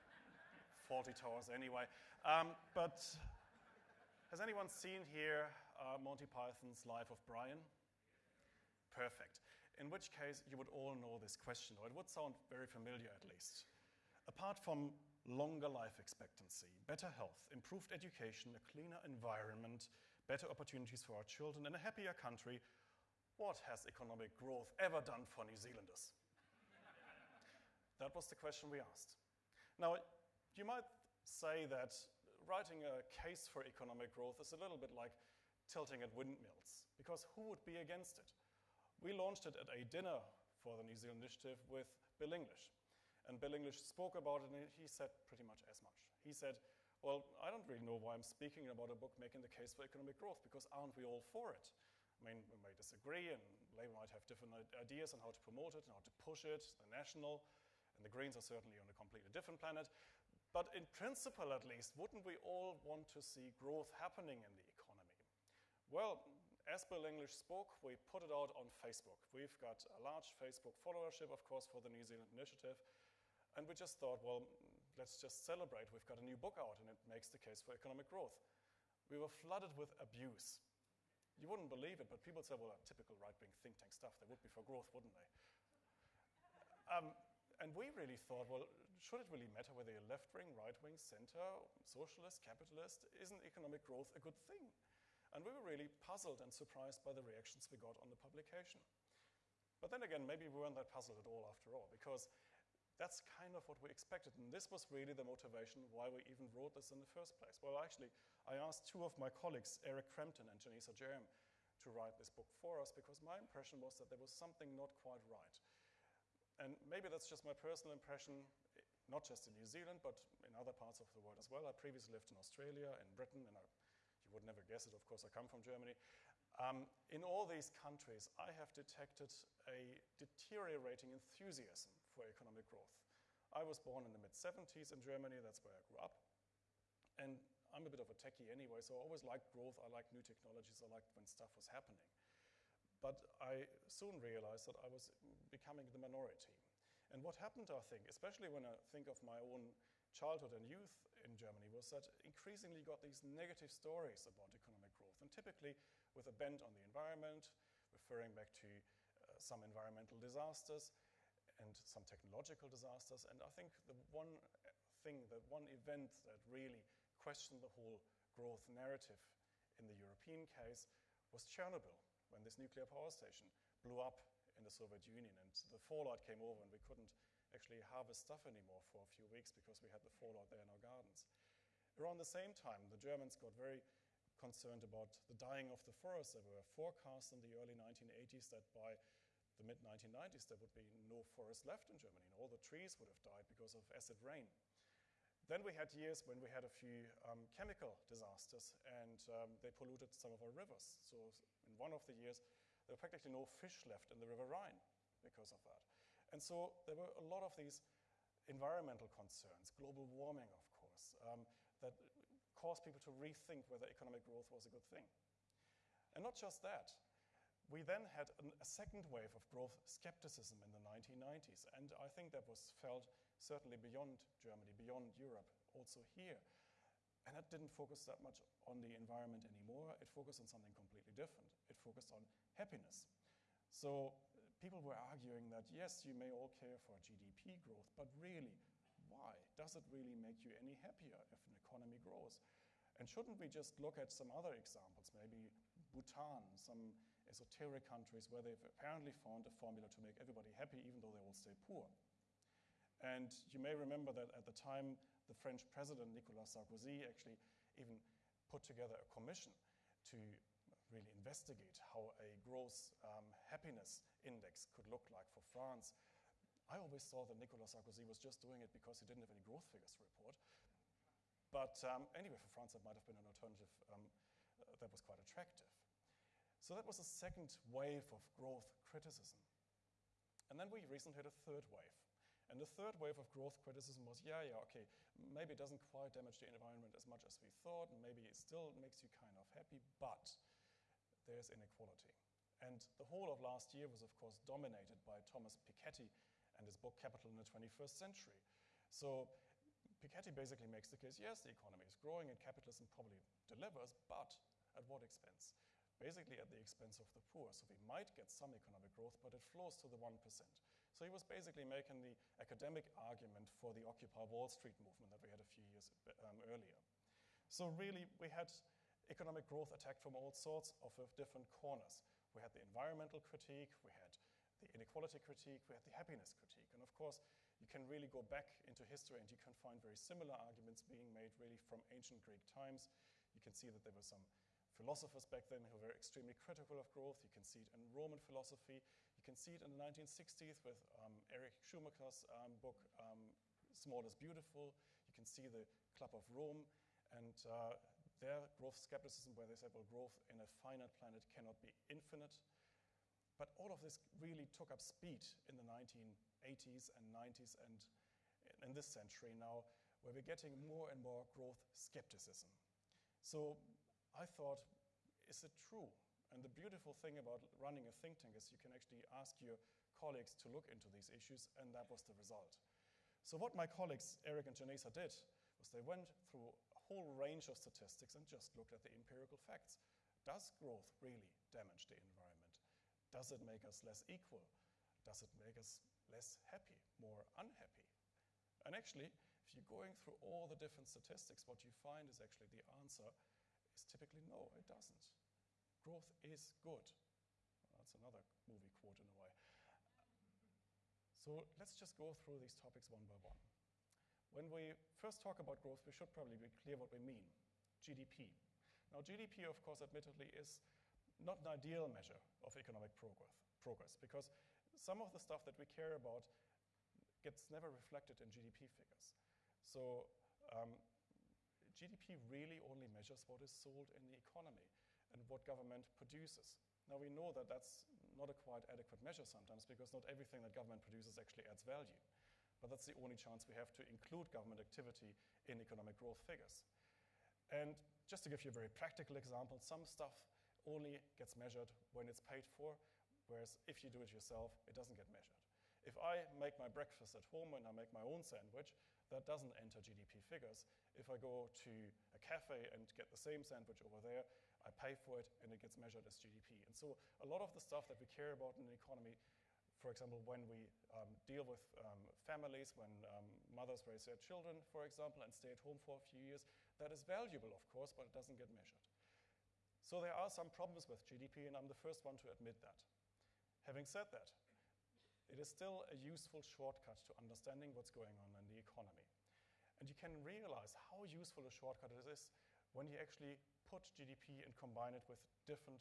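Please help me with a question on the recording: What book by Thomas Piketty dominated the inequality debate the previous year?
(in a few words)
Capital in the 21st Century.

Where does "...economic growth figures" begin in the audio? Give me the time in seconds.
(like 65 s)
435 s.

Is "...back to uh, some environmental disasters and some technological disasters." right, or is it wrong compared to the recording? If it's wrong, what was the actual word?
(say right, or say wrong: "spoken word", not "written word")
right.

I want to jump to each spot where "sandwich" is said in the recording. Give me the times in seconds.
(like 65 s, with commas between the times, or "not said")
448 s, 453 s.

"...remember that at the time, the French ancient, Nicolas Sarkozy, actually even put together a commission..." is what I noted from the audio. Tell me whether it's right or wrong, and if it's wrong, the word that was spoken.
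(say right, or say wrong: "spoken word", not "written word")
wrong: "president", not "ancient".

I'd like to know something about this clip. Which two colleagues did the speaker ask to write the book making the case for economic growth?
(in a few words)
Eric Crampton and Jenesa Jeram.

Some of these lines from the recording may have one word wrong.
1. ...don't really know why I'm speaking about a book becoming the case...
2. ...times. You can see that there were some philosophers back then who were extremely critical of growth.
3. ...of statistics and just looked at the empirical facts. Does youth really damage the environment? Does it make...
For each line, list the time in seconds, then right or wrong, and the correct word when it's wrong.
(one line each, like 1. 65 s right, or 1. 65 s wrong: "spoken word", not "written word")
1. 47 s wrong: "making", not "becoming"
2. 332 s right
3. 377 s wrong: "growth", not "youth".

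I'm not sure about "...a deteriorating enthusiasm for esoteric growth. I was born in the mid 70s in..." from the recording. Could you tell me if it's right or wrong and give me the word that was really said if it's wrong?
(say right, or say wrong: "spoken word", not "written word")
wrong: "economic", not "esoteric".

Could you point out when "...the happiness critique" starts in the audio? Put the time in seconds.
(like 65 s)
325 s.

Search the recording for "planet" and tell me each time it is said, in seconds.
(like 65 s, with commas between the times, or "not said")
59 s, 350 s.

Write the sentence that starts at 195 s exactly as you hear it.
Then we had years when we had a few um, chemical disasters and um, they polluted some of our rivers.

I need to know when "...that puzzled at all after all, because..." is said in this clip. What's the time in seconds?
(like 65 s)
100 s.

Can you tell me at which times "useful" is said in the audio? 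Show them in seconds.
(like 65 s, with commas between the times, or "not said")
475 s, 481 s.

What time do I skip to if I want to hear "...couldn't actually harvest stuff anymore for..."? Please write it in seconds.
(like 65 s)
176 s.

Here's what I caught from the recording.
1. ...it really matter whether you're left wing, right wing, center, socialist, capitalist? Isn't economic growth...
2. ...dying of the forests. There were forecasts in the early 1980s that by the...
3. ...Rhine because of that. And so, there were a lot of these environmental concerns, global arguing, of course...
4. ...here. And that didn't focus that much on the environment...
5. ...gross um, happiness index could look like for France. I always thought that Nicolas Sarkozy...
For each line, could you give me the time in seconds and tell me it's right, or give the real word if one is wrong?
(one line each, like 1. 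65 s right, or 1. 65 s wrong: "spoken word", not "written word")
1. 89 s right
2. 185 s right
3. 204 s wrong: "warming", not "arguing"
4. 226 s right
5. 262 s right.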